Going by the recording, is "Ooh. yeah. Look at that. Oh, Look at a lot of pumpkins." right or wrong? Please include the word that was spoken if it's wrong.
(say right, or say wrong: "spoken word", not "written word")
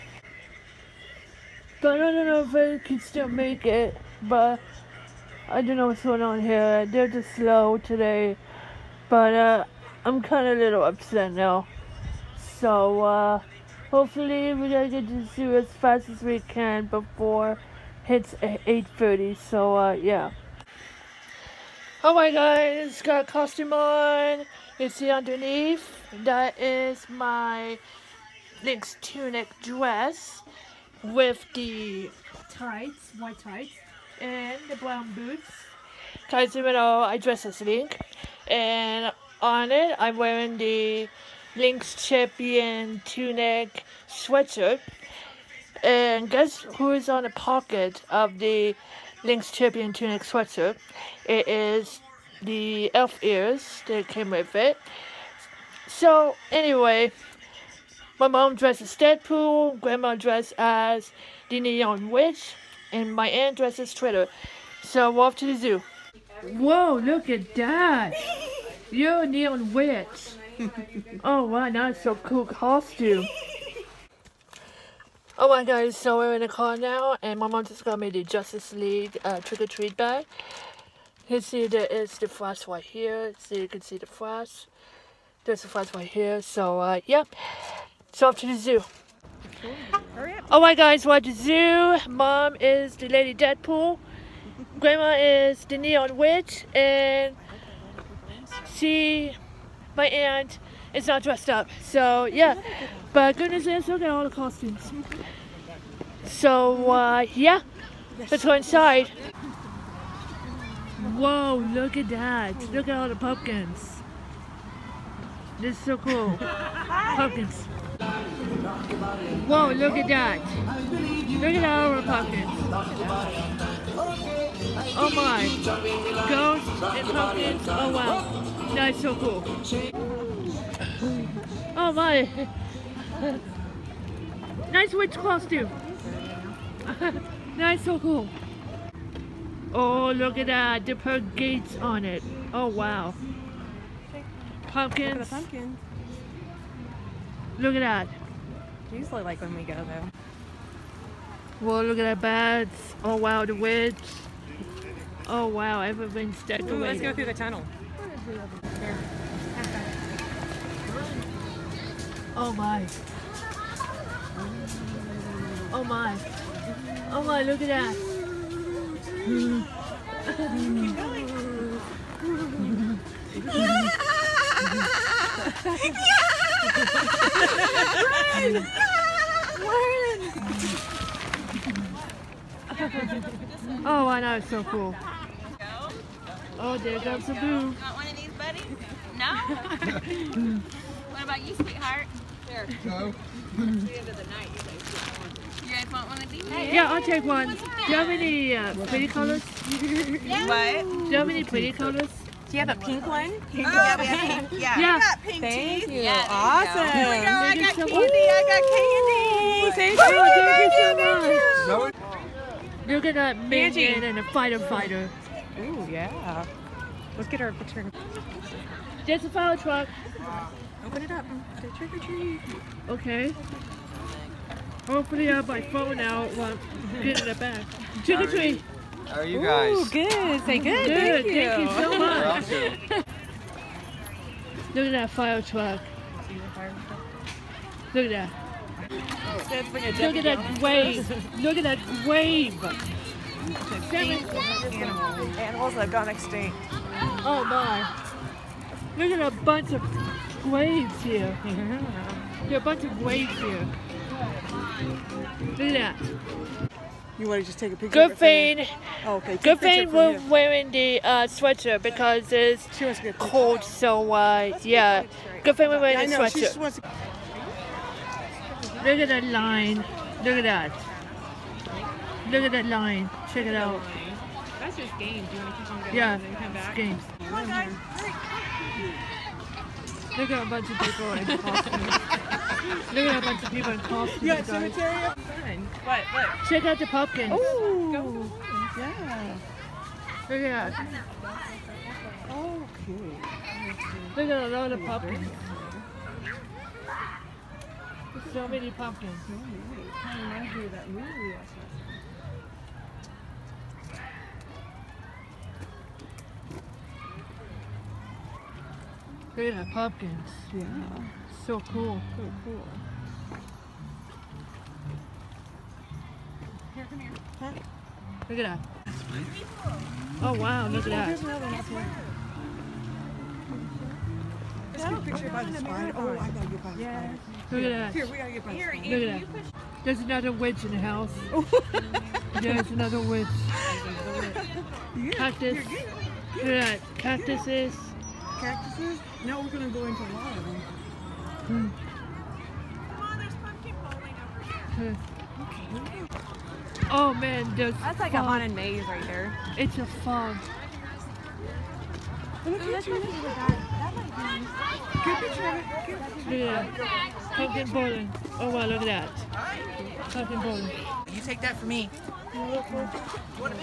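right.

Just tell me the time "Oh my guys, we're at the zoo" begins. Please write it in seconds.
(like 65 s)
90 s.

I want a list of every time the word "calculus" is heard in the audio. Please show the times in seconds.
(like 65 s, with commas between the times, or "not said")
not said.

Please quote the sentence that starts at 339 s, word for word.
Now we're going to go into a lot of them.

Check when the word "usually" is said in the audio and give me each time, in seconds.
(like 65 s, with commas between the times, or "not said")
148 s.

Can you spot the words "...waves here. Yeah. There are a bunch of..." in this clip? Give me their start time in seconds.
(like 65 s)
250 s.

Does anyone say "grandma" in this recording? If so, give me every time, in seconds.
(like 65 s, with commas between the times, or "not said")
59 s, 94 s.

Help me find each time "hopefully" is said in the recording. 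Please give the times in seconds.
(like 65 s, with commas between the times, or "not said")
13 s, 224 s.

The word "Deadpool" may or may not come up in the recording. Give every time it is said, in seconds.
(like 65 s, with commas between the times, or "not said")
58 s, 93 s.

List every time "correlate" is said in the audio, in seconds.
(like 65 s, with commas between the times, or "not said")
not said.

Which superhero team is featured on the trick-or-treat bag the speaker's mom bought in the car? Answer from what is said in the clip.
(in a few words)
Justice League.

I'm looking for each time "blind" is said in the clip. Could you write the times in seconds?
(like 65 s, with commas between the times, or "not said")
not said.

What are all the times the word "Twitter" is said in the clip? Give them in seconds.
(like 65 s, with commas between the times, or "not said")
63 s.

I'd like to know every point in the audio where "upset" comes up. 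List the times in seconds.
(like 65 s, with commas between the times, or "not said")
10 s.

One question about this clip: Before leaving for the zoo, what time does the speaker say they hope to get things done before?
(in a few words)
8:30.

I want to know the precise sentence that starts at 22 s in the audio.
Alright oh guys, got costume on.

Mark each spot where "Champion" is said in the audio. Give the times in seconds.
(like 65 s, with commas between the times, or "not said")
42 s, 49 s.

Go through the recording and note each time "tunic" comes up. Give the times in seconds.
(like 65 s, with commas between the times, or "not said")
29 s, 43 s, 49 s.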